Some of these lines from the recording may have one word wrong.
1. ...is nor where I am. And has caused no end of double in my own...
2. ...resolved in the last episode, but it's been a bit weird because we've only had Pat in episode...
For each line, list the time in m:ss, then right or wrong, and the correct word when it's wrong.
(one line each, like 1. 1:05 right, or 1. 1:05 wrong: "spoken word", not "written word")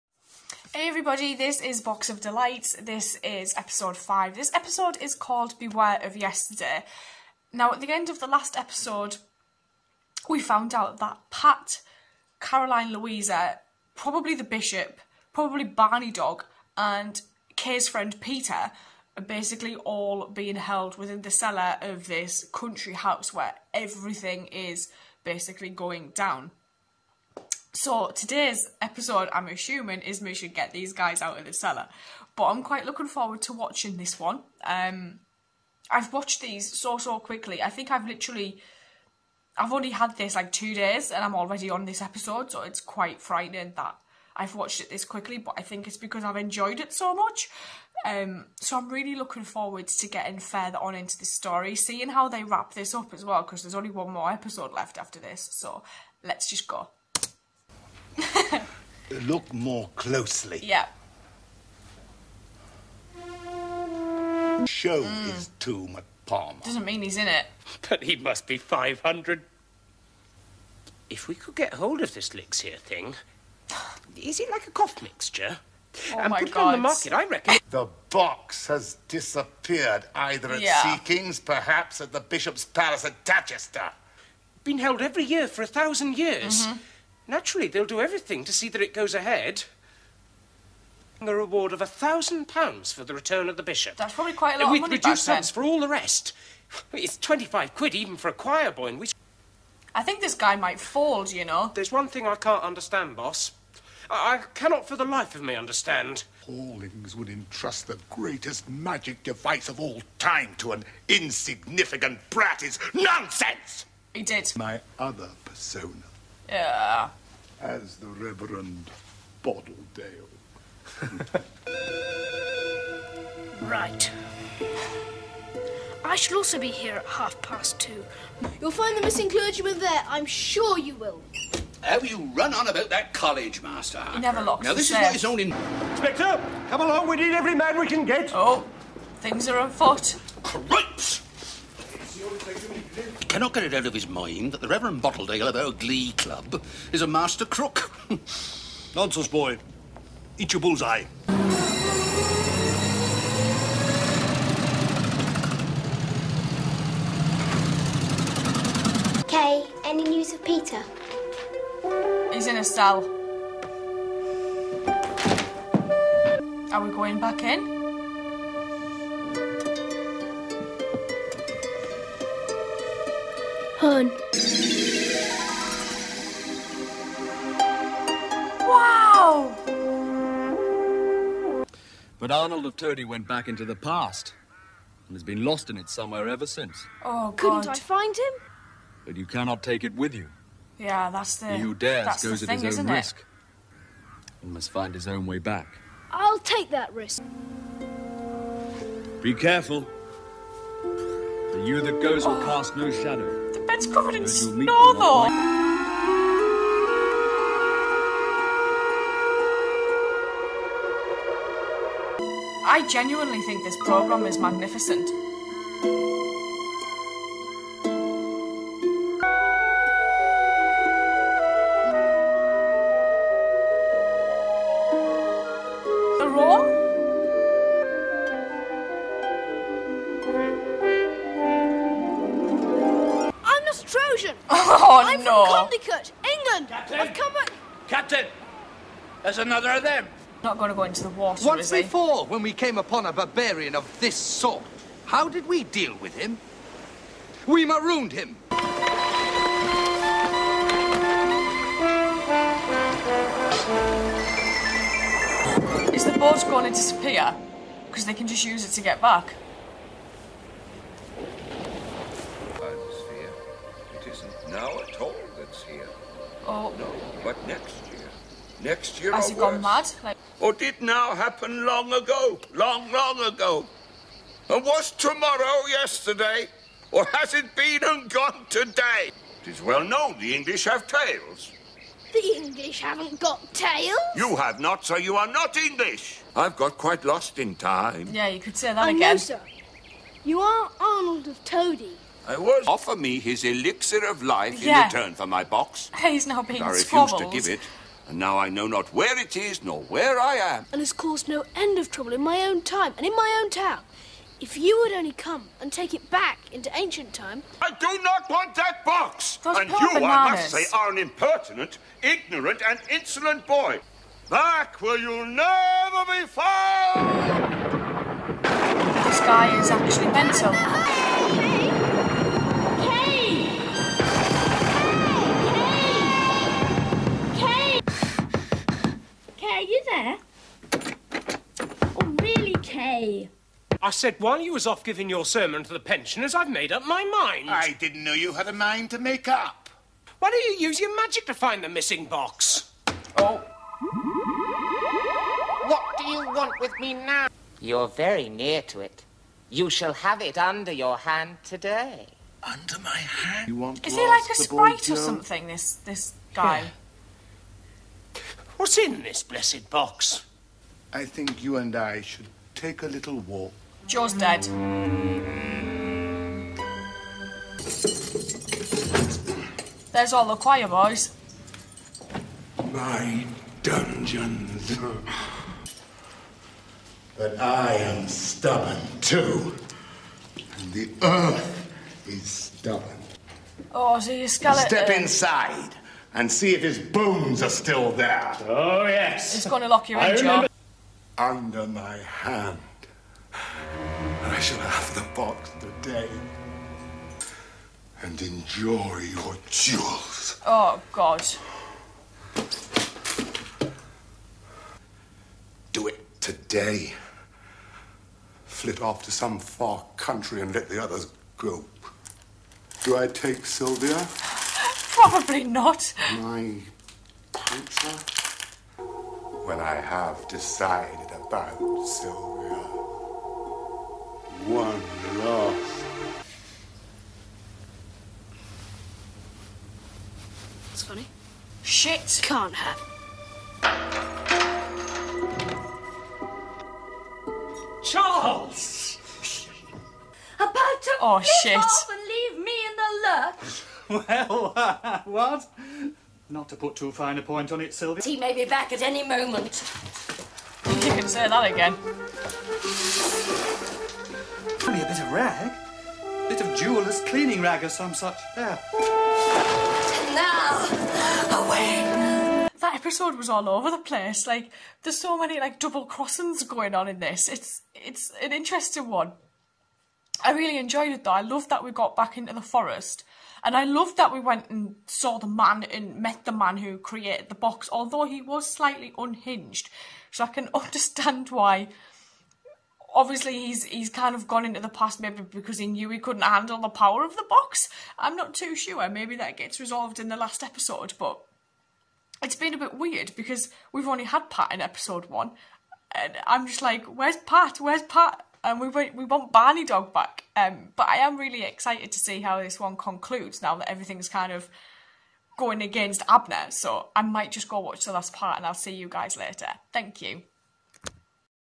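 1. 4:59 wrong: "trouble", not "double"
2. 8:09 right.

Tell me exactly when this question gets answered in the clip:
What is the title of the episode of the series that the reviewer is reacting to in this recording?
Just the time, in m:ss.
0:05.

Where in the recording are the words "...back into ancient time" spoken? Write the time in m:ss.
5:06.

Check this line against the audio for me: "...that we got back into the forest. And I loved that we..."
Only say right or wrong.
right.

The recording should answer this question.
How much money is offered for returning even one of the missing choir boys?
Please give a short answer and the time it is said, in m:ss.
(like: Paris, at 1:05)
25 quid, at 1:37.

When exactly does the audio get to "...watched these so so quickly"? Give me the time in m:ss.
0:36.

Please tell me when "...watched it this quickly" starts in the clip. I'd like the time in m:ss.
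0:44.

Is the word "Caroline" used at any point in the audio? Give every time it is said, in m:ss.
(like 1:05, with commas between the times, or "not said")
0:12.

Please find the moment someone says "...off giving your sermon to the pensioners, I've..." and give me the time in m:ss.
5:34.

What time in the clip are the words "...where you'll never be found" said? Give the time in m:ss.
5:14.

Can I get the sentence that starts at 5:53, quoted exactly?
You want Is he like a sprite or something, this, this guy?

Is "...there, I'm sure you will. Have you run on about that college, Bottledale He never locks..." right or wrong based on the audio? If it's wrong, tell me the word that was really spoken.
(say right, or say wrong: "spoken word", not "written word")
wrong: "Master", not "Bottledale".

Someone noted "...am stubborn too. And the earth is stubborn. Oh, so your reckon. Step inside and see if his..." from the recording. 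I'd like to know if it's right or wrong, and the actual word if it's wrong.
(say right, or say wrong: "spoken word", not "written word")
wrong: "skeleton", not "reckon".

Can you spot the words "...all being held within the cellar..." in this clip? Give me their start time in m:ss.
0:19.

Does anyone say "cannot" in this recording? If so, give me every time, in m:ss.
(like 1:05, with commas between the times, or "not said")
1:44, 2:23, 3:09.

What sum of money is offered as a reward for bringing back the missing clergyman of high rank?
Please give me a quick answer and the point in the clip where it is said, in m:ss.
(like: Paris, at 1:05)
1000 pounds, at 1:31.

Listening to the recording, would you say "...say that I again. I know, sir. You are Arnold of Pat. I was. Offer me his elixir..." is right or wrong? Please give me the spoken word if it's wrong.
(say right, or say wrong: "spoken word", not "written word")
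wrong: "Todi", not "Pat".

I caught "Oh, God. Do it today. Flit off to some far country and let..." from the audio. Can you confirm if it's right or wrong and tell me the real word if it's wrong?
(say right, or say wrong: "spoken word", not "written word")
right.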